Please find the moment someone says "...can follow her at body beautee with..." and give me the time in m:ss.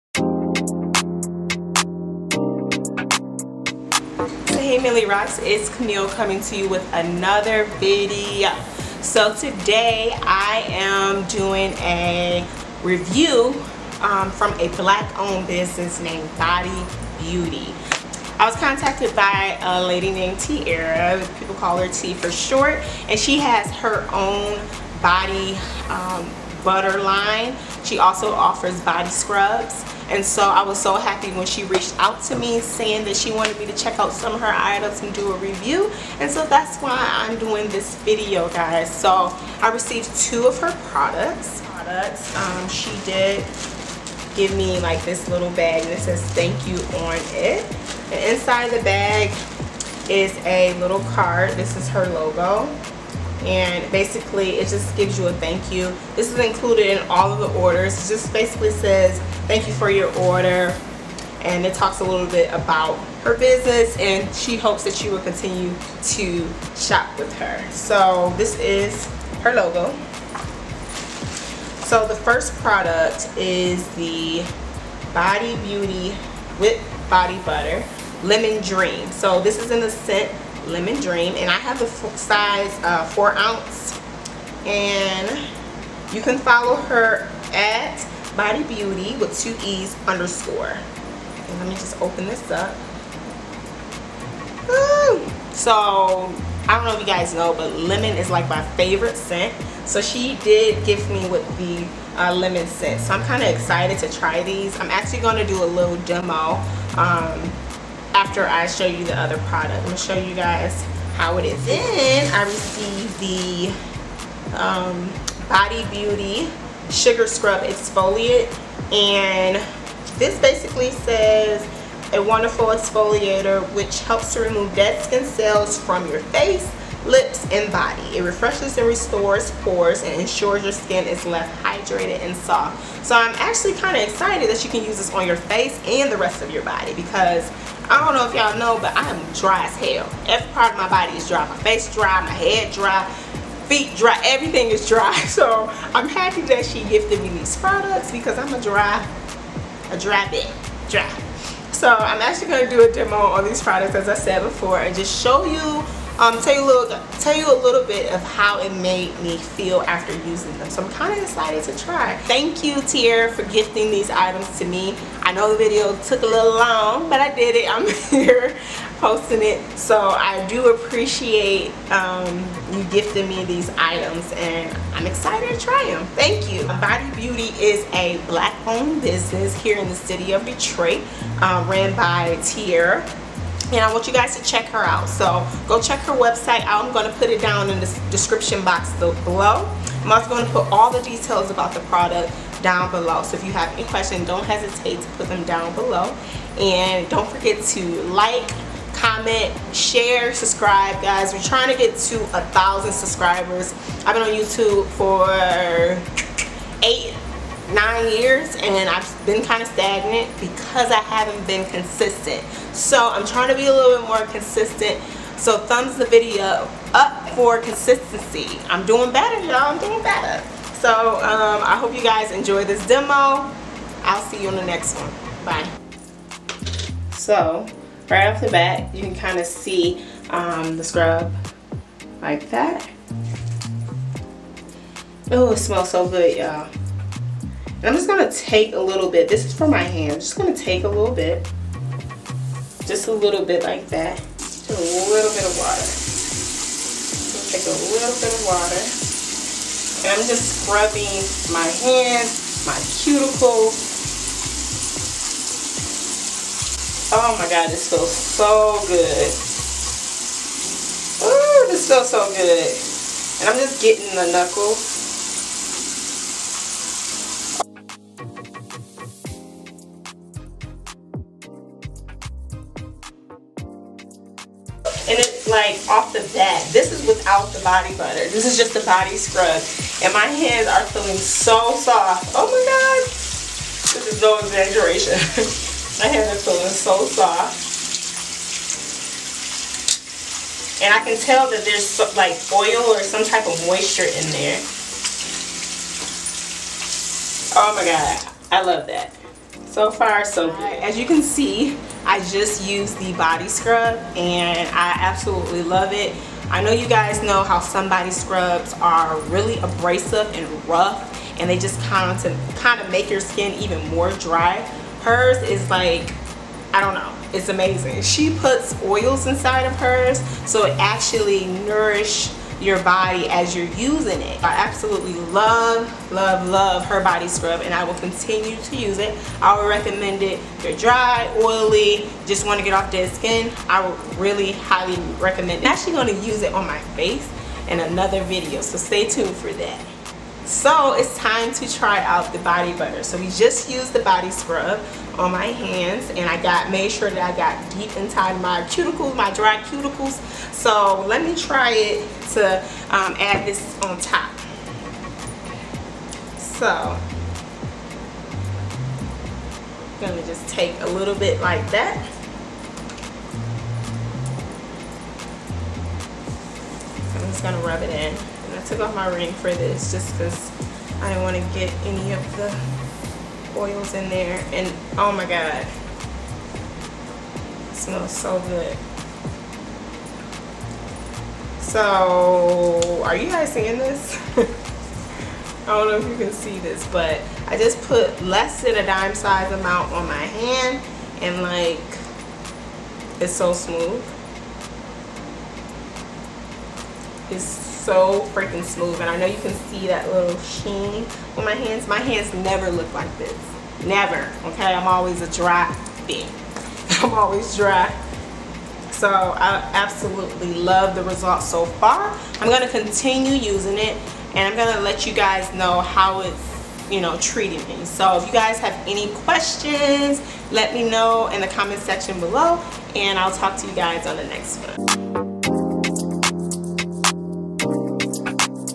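1:26.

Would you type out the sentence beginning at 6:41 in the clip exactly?
My hands never look like this.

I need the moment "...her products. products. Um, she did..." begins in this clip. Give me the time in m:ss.
0:40.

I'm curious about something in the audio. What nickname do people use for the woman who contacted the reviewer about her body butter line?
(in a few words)
Tee.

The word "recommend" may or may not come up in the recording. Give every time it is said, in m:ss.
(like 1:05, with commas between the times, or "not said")
5:29, 5:35.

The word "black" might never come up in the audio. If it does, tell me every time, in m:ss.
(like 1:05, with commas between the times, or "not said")
0:14, 2:58.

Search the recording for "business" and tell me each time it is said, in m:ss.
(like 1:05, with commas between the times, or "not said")
0:15, 1:03, 2:59.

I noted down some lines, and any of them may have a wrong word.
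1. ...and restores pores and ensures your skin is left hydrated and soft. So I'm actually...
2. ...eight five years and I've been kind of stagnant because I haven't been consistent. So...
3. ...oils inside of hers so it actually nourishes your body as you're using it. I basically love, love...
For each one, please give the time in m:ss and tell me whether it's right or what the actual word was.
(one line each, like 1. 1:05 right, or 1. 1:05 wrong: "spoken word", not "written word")
1. 2:08 right
2. 3:26 wrong: "nine", not "five"
3. 5:18 wrong: "absolutely", not "basically".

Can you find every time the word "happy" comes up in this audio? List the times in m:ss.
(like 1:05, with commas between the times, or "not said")
0:30, 2:26.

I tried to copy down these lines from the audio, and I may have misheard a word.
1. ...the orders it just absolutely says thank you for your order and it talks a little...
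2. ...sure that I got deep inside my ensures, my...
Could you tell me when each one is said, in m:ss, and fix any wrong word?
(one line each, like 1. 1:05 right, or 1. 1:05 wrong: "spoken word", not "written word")
1. 0:57 wrong: "basically", not "absolutely"
2. 5:46 wrong: "cuticles", not "ensures".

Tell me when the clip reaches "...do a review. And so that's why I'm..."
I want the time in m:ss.
0:35.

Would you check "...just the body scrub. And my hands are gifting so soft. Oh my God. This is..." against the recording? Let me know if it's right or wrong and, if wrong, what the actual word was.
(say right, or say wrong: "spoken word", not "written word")
wrong: "feeling", not "gifting".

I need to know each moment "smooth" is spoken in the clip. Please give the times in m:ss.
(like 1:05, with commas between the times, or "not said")
6:33, 6:38.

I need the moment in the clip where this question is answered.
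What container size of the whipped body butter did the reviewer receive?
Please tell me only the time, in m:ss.
1:23.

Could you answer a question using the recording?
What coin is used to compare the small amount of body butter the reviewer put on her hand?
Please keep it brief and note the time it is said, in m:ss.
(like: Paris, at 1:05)
dime, at 6:28.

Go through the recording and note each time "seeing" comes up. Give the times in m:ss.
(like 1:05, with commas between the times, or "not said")
6:23.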